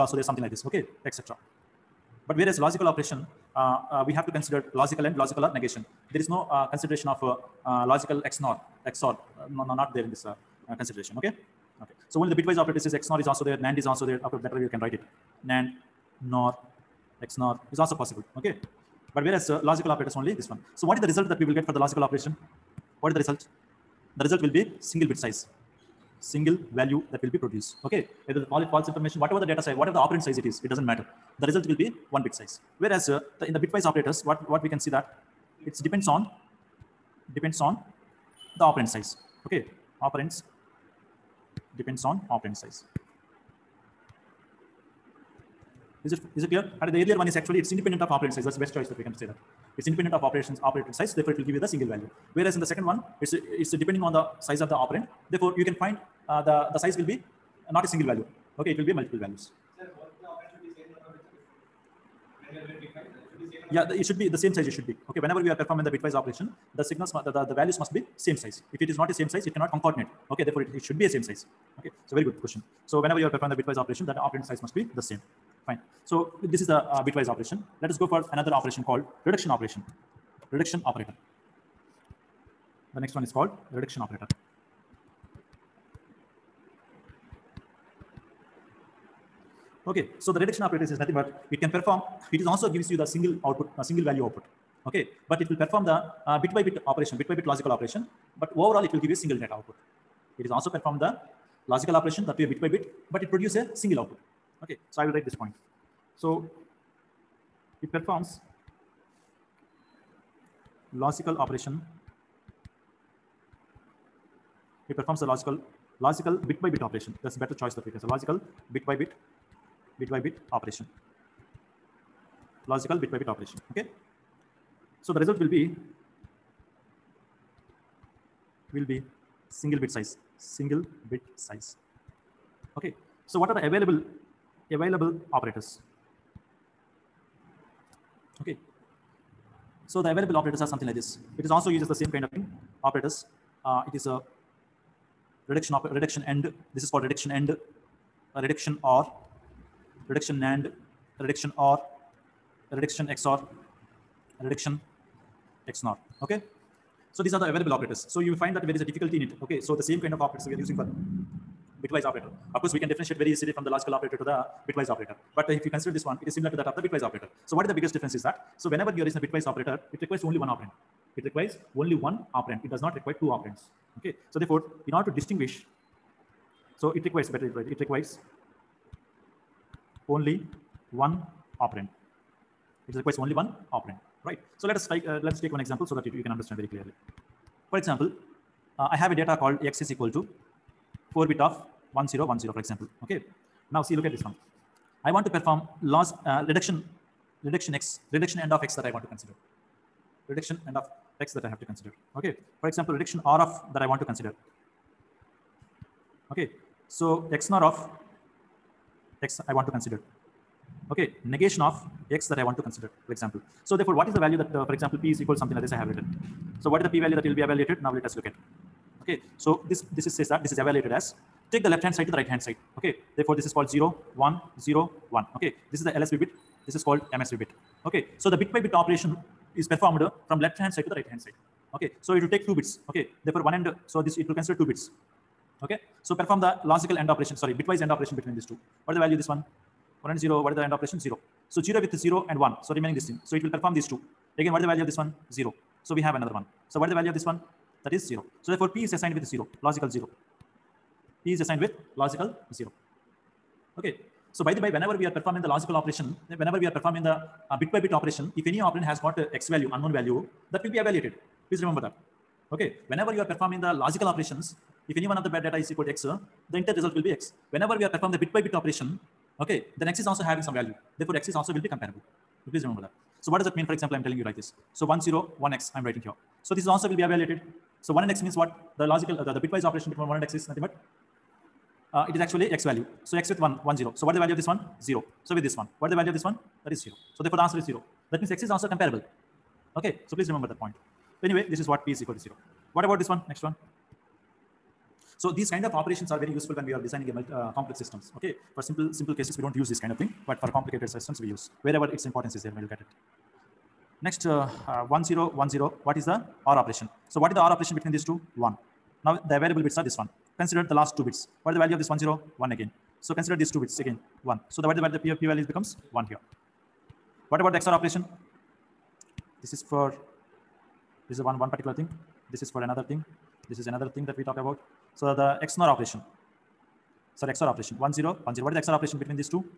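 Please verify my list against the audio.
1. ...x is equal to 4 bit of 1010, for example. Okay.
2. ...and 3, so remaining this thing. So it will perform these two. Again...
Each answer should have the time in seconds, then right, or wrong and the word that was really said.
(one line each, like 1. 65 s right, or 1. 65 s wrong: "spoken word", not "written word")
1. 189 s right
2. 242 s wrong: "1", not "3".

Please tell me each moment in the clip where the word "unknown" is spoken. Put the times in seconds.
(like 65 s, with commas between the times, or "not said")
259 s.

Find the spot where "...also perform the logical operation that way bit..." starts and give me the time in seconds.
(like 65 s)
100 s.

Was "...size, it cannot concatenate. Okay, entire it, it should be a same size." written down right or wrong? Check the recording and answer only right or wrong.
wrong.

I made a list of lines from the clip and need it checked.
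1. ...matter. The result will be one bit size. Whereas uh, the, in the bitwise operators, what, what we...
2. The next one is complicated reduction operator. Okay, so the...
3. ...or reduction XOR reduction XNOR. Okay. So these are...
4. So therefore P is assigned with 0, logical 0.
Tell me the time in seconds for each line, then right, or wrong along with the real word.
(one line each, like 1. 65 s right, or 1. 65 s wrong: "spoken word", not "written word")
1. 30 s right
2. 82 s wrong: "called", not "complicated"
3. 151 s right
4. 248 s right.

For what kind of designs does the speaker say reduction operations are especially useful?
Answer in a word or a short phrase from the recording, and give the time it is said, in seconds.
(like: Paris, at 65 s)
Complex systems, at 297 s.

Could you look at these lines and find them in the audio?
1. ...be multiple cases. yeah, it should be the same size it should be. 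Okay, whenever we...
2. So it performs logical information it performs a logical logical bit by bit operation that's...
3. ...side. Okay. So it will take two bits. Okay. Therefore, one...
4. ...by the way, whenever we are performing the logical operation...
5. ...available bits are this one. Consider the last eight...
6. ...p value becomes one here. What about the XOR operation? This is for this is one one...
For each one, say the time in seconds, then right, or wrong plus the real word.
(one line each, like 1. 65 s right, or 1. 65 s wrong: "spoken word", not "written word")
1. 58 s wrong: "values", not "cases"
2. 106 s wrong: "operation", not "information"
3. 231 s right
4. 254 s right
5. 309 s wrong: "two", not "eight"
6. 315 s right.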